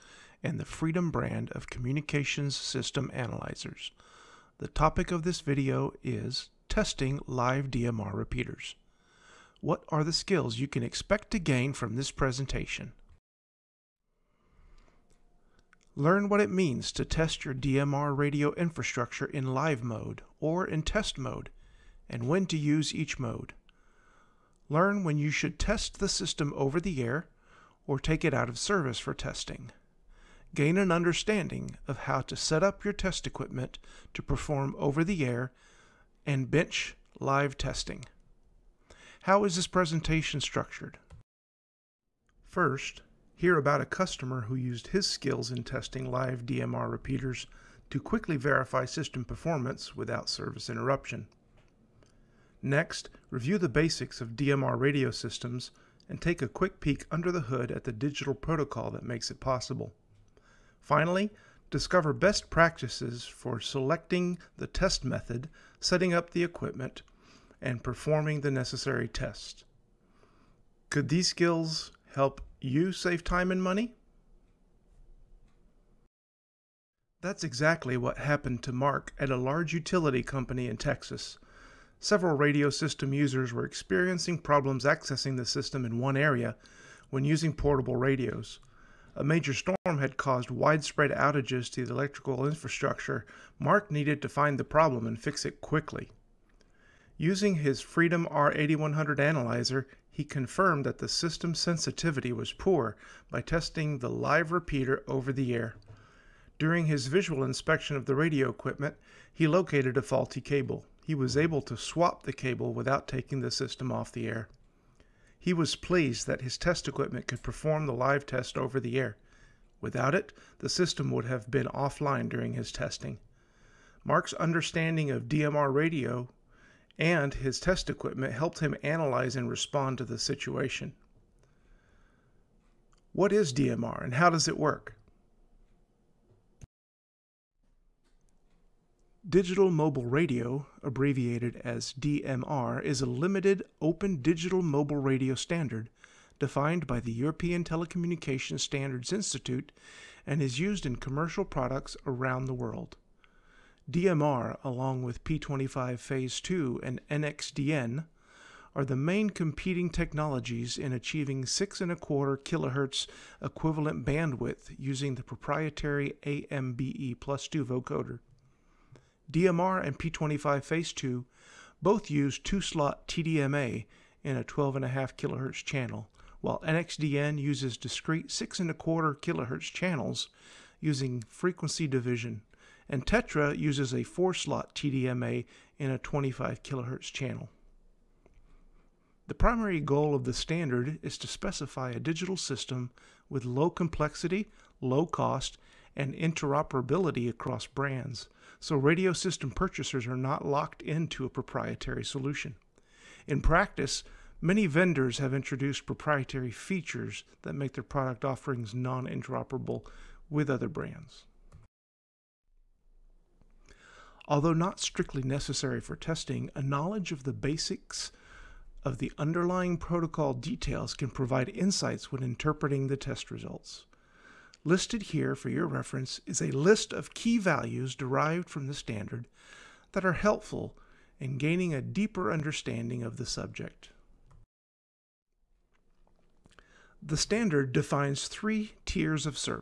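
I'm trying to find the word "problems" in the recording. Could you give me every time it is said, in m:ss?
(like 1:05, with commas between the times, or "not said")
1:24, 1:34.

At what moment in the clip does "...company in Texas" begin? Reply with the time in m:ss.
1:20.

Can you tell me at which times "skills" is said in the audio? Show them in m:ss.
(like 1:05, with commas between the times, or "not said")
0:10, 0:45, 1:11.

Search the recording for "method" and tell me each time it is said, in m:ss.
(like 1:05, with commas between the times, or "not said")
1:05.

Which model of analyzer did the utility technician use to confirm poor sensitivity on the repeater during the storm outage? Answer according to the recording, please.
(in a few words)
Freedom R8100.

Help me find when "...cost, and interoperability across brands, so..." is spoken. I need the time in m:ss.
3:15.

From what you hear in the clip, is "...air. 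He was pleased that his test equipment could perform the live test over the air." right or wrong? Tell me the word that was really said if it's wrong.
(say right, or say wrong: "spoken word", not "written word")
right.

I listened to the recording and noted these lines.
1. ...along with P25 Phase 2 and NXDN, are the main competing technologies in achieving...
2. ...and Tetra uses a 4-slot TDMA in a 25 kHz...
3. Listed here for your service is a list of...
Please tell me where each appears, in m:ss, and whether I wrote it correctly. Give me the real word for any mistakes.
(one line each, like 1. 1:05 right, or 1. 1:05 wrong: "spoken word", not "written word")
1. 2:34 right
2. 3:02 right
3. 3:44 wrong: "reference", not "service".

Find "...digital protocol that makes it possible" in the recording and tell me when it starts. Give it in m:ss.
0:57.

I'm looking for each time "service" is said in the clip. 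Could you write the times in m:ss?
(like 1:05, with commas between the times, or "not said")
0:28, 0:50.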